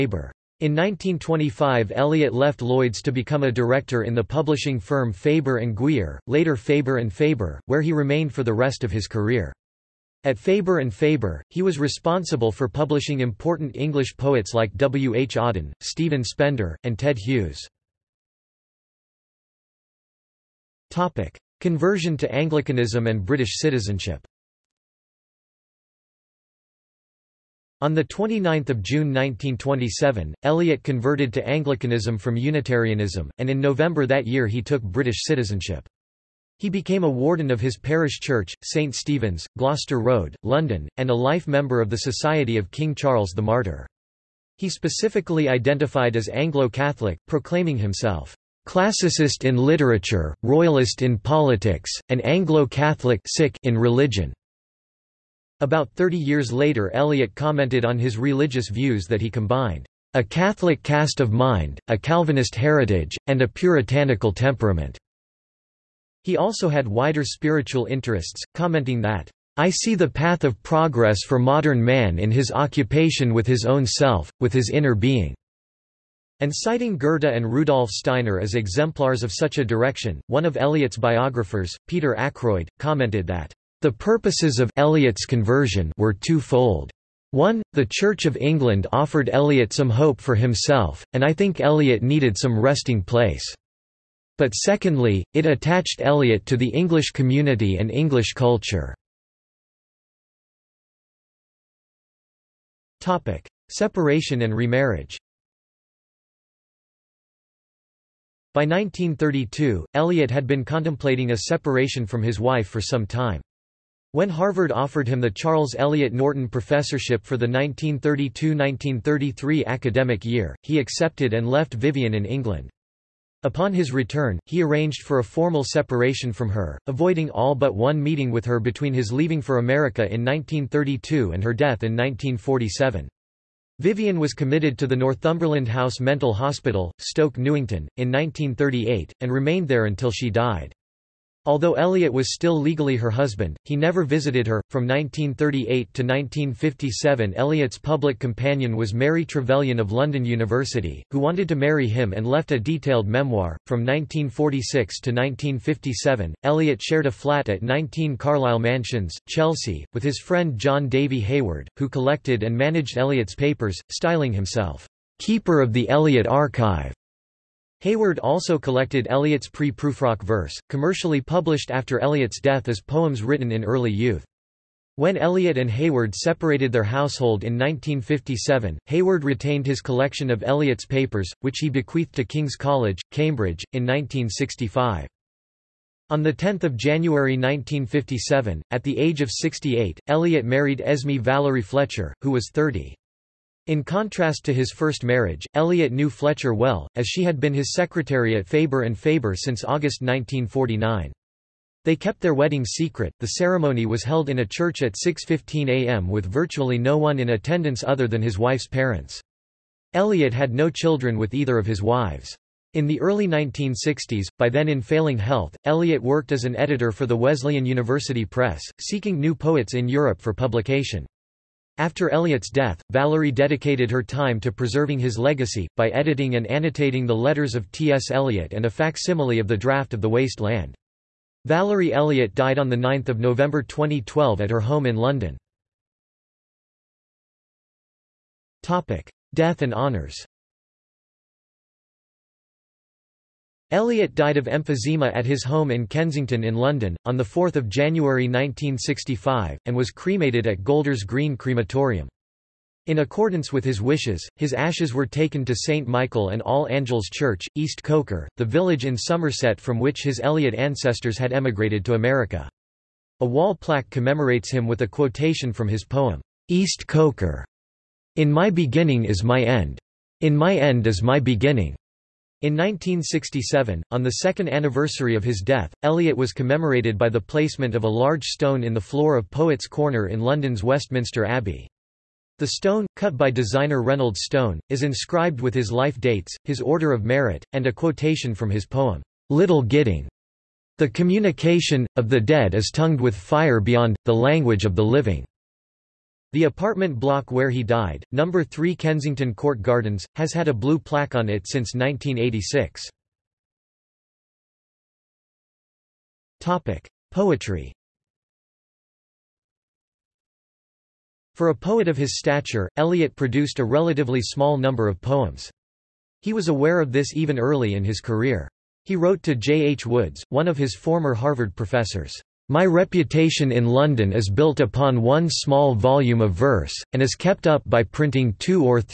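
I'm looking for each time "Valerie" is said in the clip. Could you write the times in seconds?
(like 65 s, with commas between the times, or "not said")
191 s, 222 s, 231 s.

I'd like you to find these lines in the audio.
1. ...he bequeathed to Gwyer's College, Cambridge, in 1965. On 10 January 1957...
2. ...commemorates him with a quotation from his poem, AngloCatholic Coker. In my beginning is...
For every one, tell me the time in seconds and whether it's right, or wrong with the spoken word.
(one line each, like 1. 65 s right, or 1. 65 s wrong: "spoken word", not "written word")
1. 181 s wrong: "King", not "Gwyer"
2. 263 s wrong: "East", not "AngloCatholic".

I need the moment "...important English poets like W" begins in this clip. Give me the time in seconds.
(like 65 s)
13 s.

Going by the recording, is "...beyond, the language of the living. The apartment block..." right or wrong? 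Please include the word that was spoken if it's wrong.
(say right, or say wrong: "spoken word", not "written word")
right.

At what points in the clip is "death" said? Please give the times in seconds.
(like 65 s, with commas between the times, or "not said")
131 s, 172 s, 222 s, 239 s, 275 s.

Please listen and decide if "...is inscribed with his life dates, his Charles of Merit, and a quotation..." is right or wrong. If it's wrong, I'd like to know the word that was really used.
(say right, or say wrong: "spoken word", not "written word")
wrong: "Order", not "Charles".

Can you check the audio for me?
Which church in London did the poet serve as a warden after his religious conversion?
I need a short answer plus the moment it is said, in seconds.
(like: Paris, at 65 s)
St Stephen's, Gloucester Road, at 38 s.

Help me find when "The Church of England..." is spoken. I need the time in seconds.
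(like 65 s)
87 s.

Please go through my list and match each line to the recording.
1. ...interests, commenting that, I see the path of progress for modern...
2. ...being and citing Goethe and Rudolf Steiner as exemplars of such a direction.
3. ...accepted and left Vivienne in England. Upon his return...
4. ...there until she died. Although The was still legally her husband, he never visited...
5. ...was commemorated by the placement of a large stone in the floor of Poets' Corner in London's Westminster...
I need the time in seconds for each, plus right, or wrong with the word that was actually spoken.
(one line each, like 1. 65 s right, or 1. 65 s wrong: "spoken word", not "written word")
1. 67 s right
2. 74 s right
3. 120 s right
4. 139 s wrong: "Eliot", not "The"
5. 276 s right.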